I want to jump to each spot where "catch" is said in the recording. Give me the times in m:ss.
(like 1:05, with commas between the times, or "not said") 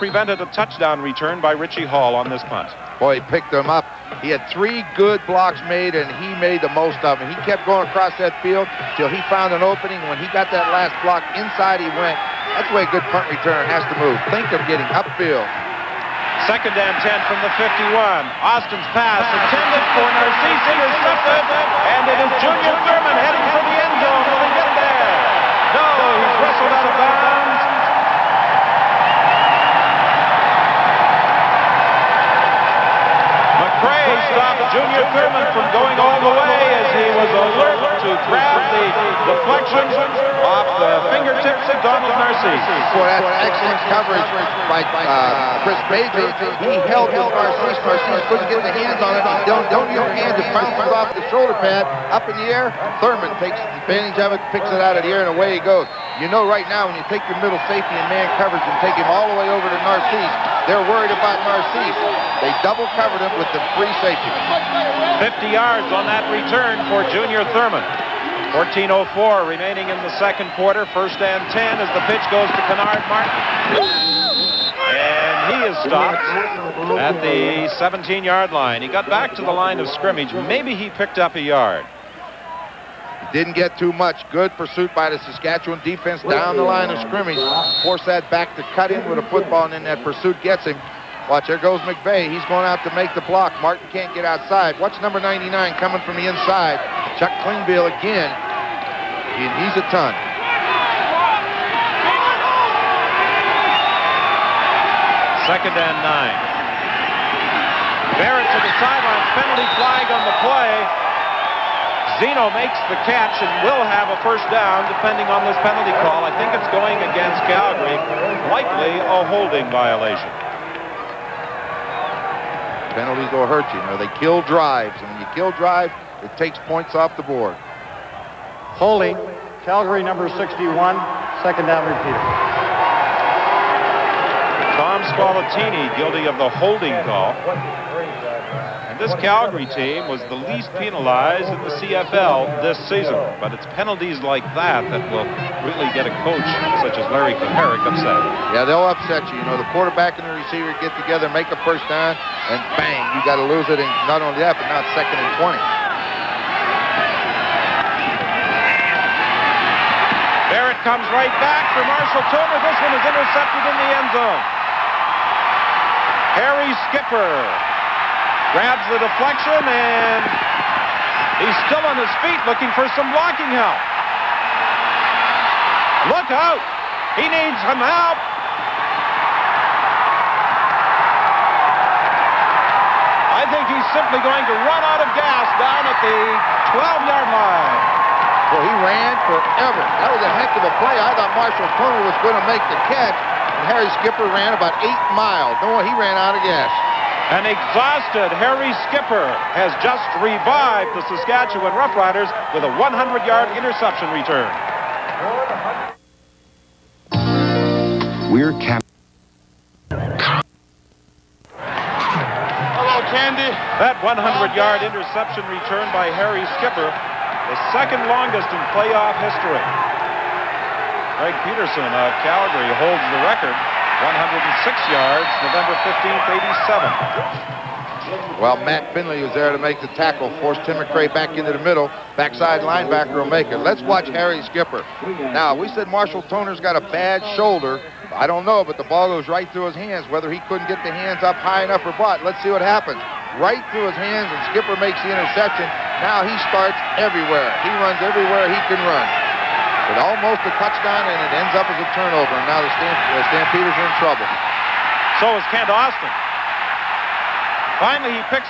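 1:53, 3:12.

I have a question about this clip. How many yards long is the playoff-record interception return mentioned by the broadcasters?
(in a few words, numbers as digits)
106.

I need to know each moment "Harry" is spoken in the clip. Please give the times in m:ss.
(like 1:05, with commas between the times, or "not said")
2:46, 3:13, 3:18, 3:36, 3:54.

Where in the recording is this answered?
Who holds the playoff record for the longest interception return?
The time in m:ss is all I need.
3:41.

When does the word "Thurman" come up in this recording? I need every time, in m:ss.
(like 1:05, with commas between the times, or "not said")
0:22, 0:35, 0:53, 1:07.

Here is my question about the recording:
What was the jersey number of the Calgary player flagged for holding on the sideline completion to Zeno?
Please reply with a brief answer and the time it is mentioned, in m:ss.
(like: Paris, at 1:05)
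61, at 2:10.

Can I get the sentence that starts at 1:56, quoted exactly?
I think it's going against Calgary.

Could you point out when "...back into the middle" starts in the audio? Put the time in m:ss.
3:51.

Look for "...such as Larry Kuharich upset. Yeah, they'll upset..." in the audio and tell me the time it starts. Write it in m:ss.
2:26.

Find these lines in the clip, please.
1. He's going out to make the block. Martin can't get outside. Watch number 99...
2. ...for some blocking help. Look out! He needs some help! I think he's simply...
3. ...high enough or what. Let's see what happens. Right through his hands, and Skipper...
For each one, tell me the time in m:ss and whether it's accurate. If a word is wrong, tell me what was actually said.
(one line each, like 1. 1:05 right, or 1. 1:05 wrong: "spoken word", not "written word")
1. 1:32 right
2. 2:52 right
3. 4:01 right.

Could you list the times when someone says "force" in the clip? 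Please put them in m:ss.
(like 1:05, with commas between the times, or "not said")
1:27, 3:50.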